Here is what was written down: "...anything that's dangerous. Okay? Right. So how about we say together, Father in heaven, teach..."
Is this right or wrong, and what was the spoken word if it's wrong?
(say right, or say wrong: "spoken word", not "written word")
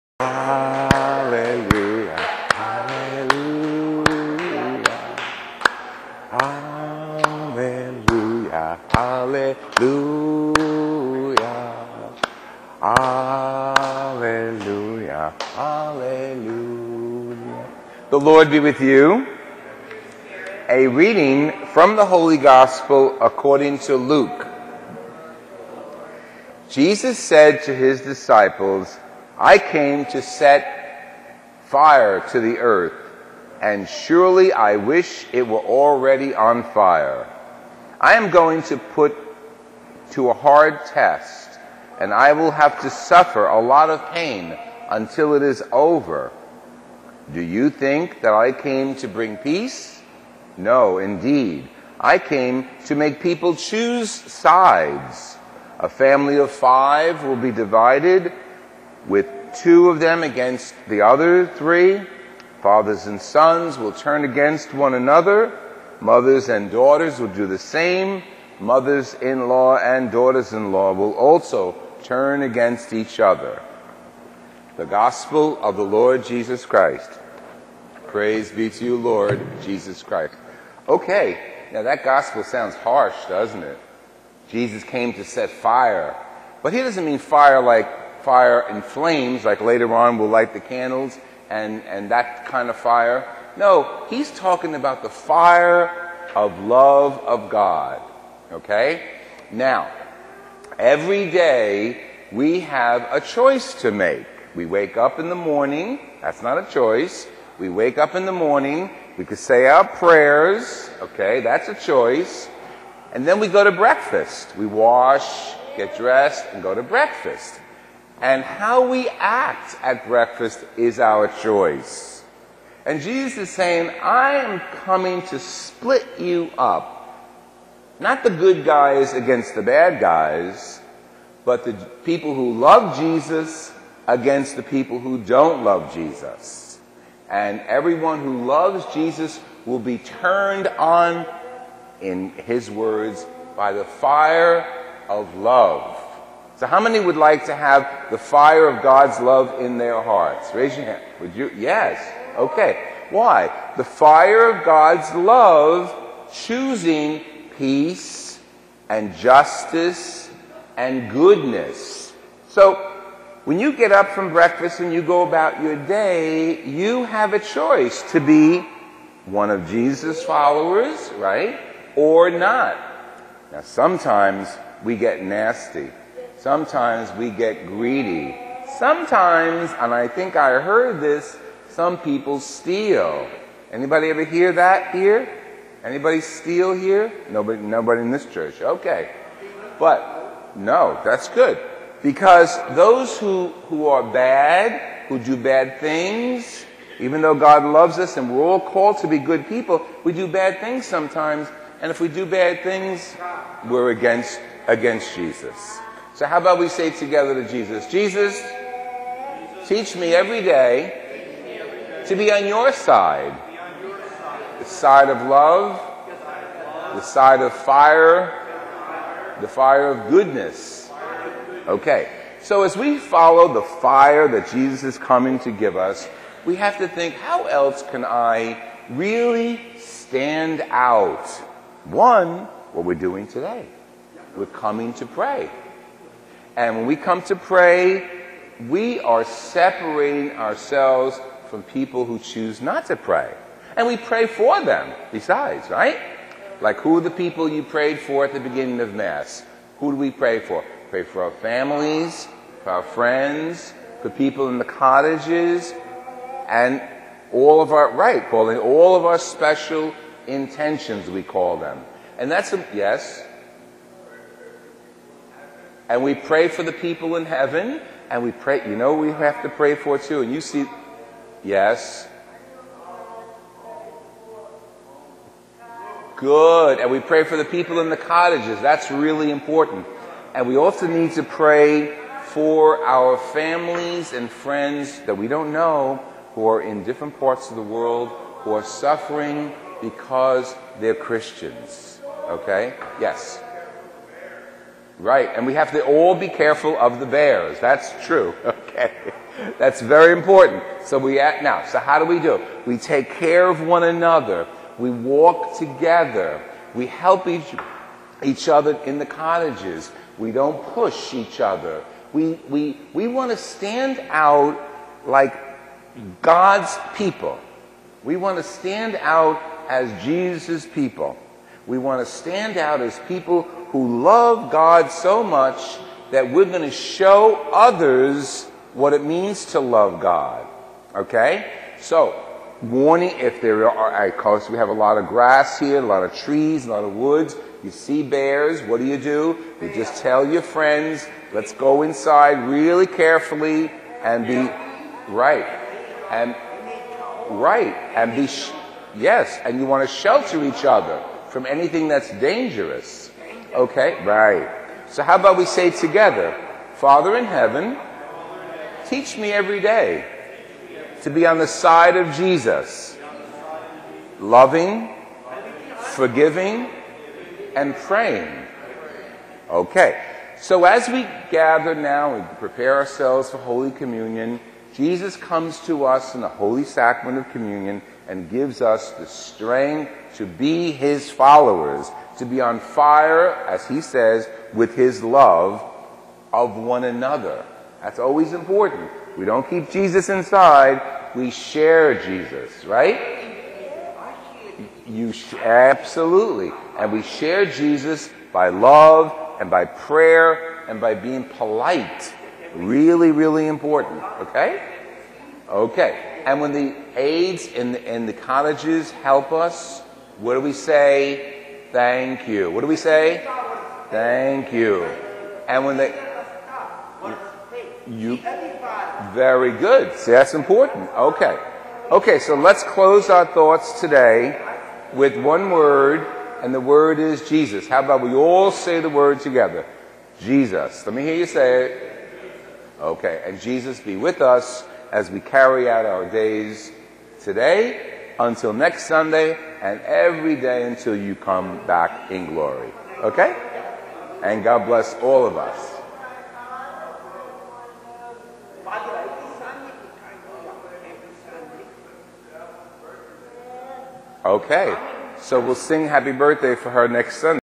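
right.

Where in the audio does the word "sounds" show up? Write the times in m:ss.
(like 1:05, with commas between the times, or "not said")
1:22.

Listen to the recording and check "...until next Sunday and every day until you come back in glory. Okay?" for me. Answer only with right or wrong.
right.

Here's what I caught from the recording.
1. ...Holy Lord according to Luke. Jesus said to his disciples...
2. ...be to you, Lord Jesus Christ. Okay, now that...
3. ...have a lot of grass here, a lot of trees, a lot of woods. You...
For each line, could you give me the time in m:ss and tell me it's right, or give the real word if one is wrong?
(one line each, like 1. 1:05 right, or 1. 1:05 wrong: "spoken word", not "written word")
1. 0:22 wrong: "Gospel", not "Lord"
2. 1:18 right
3. 5:34 right.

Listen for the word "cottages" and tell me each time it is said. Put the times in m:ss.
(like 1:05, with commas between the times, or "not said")
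4:14, 4:37, 5:09, 6:48.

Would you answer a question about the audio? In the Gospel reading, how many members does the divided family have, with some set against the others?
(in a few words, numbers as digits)
5.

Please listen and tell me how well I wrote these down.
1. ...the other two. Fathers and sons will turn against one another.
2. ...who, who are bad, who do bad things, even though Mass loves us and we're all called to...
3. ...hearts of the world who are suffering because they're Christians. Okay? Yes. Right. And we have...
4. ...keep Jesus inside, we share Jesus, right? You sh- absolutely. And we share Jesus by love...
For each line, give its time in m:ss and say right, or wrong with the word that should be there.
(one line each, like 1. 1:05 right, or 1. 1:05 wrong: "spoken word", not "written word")
1. 1:00 wrong: "three", not "two"
2. 3:13 wrong: "God", not "Mass"
3. 4:47 wrong: "parts", not "hearts"
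4. 6:29 right.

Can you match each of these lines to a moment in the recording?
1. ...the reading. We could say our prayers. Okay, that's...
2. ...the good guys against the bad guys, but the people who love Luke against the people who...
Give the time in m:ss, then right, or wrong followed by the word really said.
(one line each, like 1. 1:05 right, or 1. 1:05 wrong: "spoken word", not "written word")
1. 1:48 wrong: "morning", not "reading"
2. 2:08 wrong: "Jesus", not "Luke".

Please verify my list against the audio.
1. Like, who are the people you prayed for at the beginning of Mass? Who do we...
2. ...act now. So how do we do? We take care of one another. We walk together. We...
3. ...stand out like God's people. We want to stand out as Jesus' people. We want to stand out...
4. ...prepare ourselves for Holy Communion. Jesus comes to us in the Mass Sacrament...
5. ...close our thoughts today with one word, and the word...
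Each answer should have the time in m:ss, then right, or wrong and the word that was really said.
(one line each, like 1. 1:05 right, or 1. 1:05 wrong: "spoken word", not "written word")
1. 4:06 right
2. 5:01 right
3. 5:13 right
4. 6:12 wrong: "Holy", not "Mass"
5. 7:02 right.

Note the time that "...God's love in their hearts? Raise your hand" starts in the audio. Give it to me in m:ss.
2:28.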